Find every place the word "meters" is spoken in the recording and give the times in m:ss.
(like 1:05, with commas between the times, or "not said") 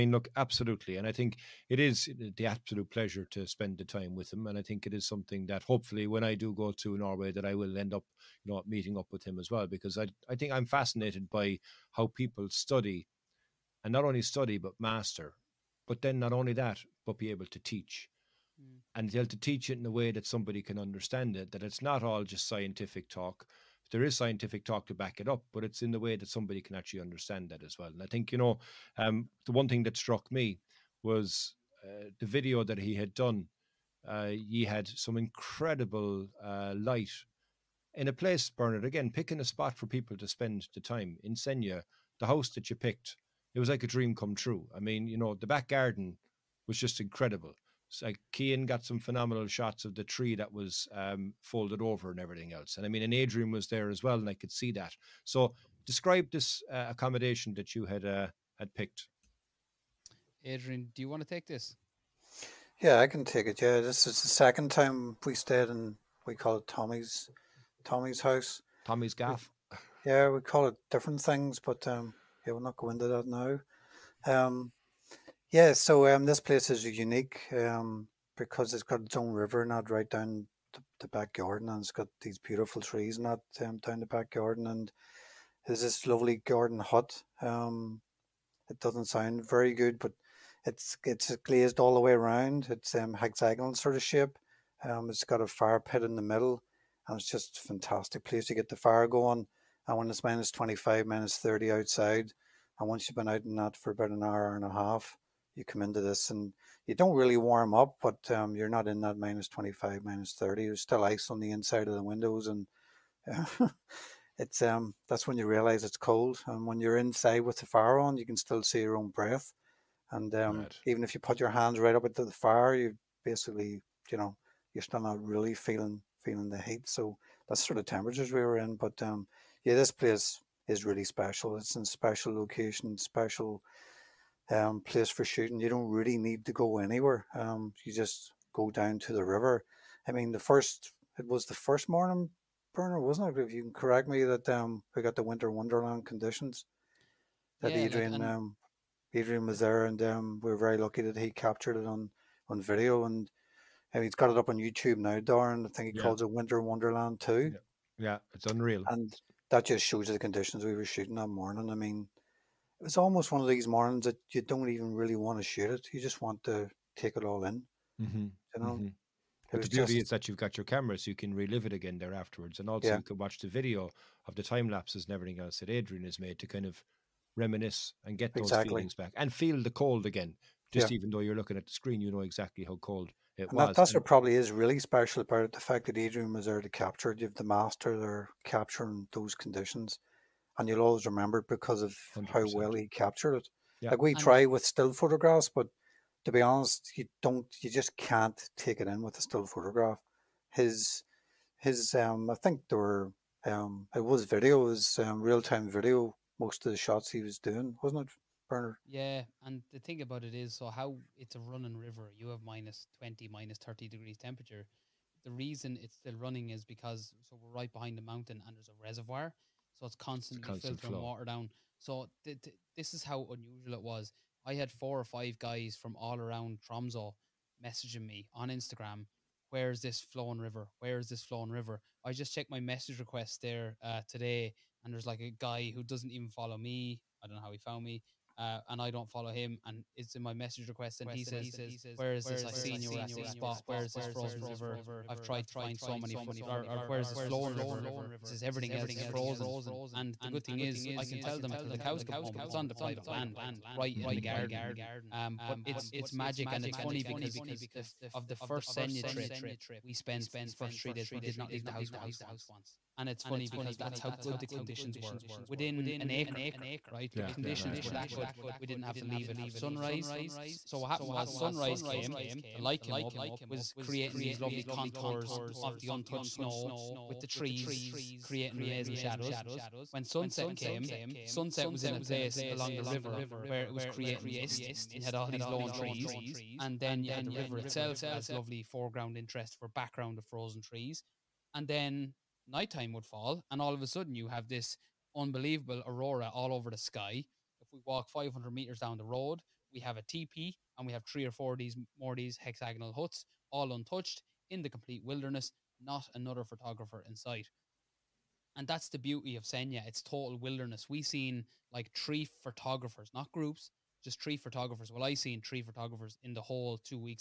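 4:58.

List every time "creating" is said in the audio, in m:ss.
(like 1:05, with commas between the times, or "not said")
4:33, 4:38, 4:43.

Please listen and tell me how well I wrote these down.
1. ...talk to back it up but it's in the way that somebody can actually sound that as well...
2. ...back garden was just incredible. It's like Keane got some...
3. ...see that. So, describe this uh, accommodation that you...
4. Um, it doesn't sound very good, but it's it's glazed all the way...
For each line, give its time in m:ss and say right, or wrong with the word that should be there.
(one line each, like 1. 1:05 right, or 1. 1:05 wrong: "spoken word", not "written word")
1. 0:24 wrong: "understand", not "sound"
2. 0:45 right
3. 0:54 right
4. 1:27 right.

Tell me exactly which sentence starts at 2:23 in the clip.
If you can correct me, that um, we got the winter wonderland conditions.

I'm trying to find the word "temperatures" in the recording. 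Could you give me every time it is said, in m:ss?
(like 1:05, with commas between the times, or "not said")
2:07, 3:34.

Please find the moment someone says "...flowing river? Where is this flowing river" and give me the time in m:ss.
3:50.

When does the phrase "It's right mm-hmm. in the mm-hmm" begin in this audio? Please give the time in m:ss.
4:13.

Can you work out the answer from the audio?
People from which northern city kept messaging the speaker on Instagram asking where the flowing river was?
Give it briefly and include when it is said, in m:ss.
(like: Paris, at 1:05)
Tromso, at 3:46.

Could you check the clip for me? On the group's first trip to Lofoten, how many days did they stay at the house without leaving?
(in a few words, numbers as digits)
3.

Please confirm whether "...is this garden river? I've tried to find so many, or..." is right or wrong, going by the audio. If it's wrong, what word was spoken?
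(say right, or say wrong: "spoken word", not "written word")
wrong: "frozen", not "garden".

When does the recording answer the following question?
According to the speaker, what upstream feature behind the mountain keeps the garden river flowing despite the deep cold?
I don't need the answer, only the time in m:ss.
3:38.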